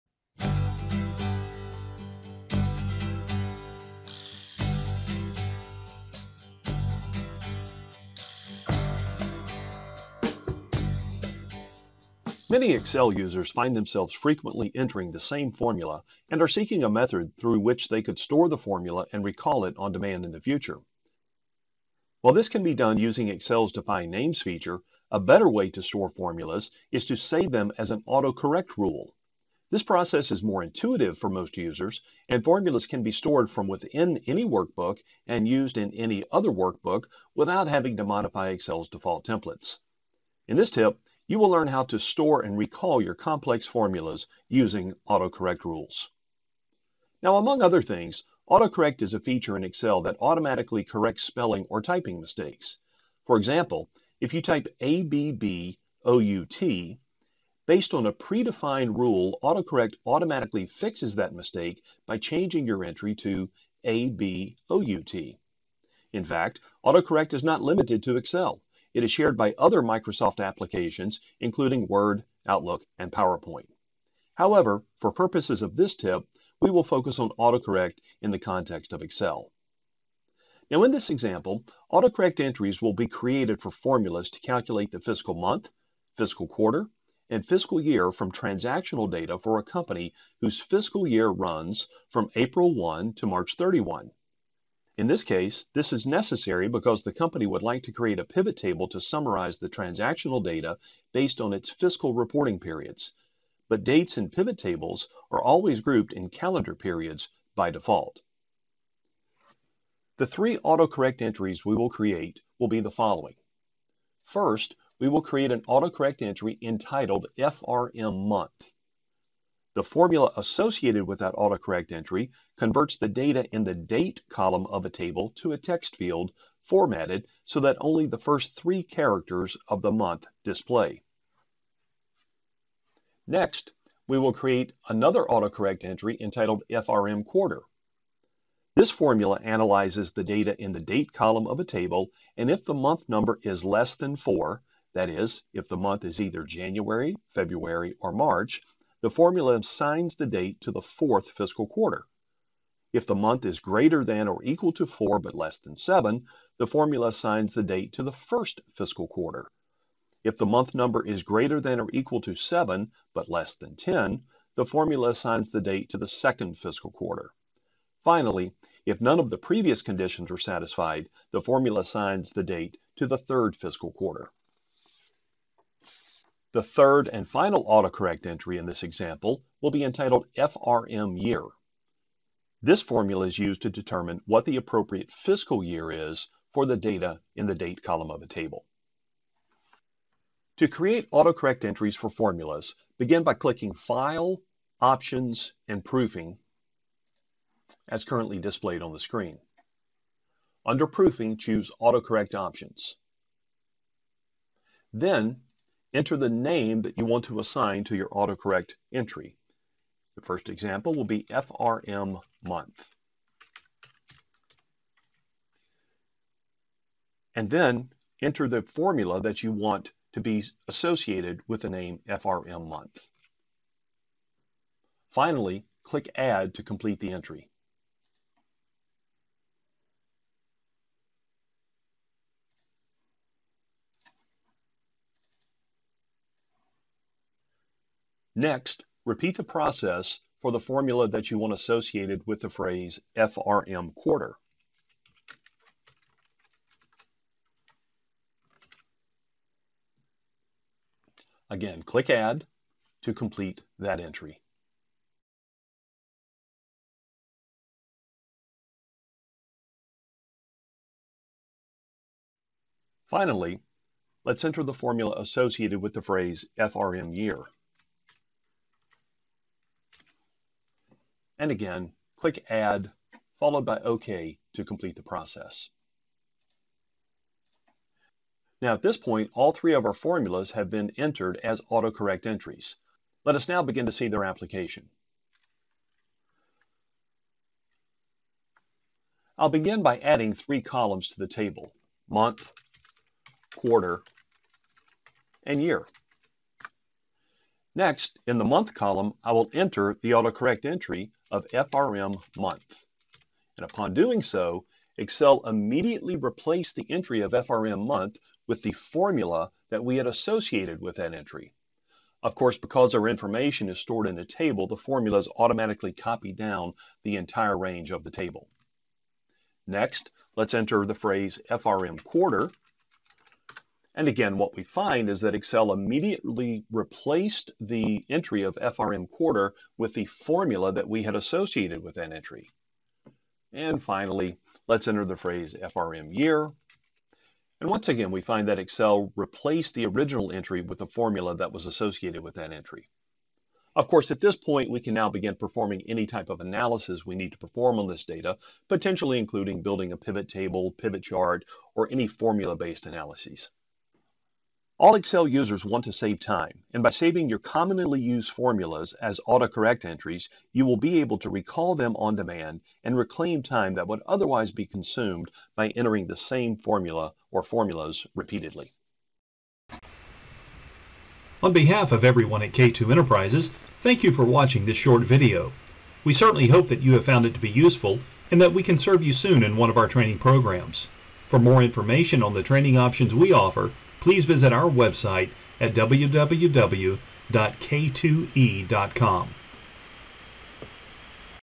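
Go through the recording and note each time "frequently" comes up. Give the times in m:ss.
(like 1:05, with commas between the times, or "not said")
0:14.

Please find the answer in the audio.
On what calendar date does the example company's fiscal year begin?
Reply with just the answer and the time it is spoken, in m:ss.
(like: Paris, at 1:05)
April 1, at 1:32.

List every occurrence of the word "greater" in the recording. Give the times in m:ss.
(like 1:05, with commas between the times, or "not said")
2:33, 2:41.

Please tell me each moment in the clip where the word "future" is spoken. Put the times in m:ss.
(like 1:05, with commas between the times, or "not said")
0:20.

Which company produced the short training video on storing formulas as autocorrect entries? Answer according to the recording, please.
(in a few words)
K2 Enterprises.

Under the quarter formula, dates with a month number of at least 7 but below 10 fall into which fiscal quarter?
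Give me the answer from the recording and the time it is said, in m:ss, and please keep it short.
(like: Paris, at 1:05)
Second, at 2:46.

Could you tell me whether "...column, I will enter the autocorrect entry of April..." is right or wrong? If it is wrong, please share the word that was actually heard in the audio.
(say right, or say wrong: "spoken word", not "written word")
wrong: "FRM", not "April".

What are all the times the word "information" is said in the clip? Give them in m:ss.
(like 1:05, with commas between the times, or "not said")
5:13, 6:21.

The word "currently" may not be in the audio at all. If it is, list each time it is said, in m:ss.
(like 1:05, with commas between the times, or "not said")
3:18.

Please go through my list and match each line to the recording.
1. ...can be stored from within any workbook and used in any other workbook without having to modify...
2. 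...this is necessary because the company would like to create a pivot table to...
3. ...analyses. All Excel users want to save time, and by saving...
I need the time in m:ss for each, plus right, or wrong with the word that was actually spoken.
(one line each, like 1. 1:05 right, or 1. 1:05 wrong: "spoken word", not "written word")
1. 0:32 right
2. 1:35 right
3. 5:52 right.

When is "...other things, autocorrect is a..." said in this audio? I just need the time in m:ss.
0:47.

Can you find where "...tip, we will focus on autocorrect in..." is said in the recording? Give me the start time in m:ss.
1:15.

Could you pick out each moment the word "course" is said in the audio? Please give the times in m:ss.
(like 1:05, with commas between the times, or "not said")
5:12, 5:43.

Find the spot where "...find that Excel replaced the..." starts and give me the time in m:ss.
5:38.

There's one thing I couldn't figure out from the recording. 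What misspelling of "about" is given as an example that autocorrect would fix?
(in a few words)
ABBOUT.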